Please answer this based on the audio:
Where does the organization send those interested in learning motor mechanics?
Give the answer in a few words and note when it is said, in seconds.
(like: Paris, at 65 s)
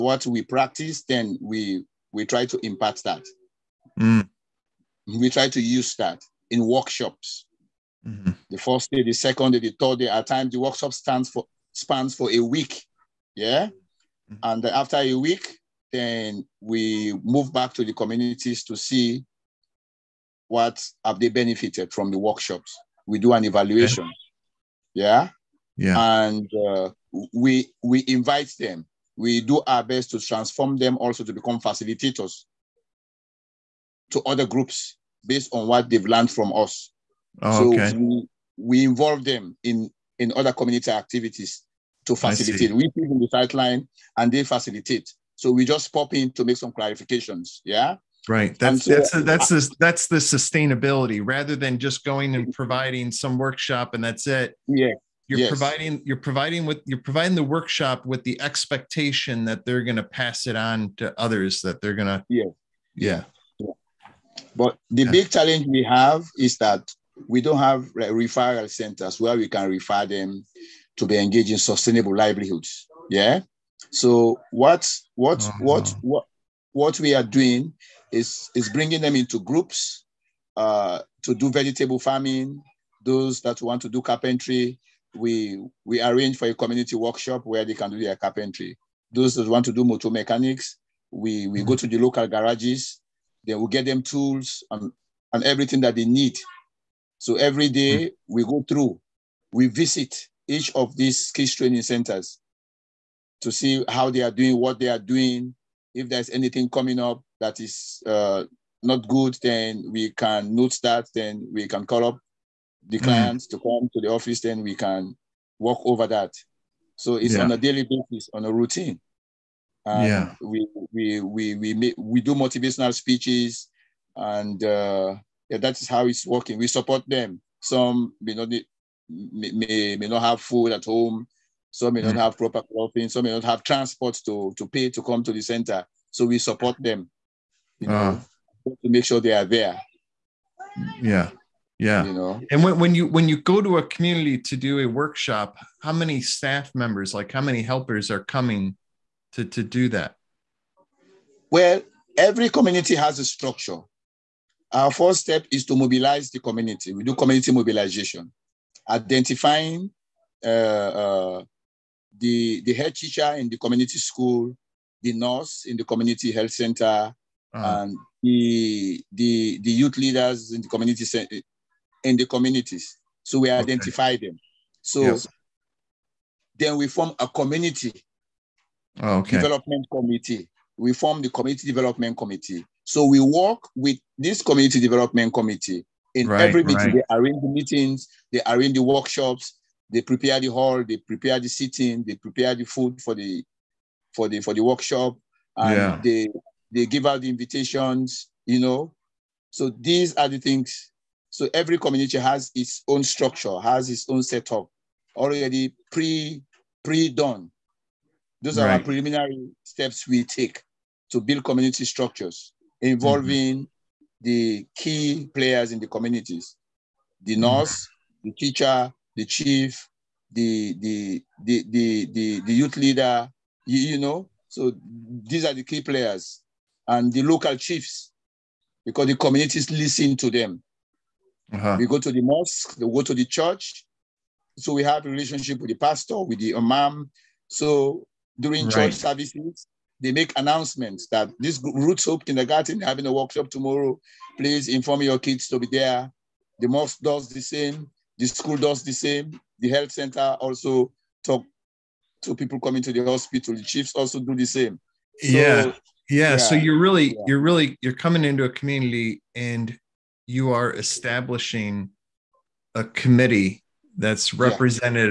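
local garages, at 91 s.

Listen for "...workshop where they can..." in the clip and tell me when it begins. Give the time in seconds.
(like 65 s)
86 s.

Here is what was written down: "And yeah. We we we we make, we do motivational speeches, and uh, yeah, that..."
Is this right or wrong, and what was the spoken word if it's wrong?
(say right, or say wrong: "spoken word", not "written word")
right.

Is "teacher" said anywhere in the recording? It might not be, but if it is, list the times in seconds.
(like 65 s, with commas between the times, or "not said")
162 s, 218 s.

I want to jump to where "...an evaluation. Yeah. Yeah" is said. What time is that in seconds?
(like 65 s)
23 s.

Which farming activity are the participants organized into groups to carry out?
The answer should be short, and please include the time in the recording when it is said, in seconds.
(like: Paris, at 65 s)
vegetable farming, at 81 s.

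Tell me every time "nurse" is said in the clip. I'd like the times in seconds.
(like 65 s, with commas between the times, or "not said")
165 s, 217 s.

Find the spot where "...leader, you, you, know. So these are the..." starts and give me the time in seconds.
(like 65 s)
222 s.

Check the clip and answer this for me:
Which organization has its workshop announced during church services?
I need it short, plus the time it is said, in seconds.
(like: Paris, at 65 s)
Ruth's Hope Kindergarten, at 241 s.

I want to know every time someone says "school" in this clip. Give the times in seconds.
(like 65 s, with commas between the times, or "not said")
163 s, 248 s.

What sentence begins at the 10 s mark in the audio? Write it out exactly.
At times, the workshop stands for spans for a week.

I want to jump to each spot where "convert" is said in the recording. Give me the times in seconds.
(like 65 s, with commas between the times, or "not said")
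not said.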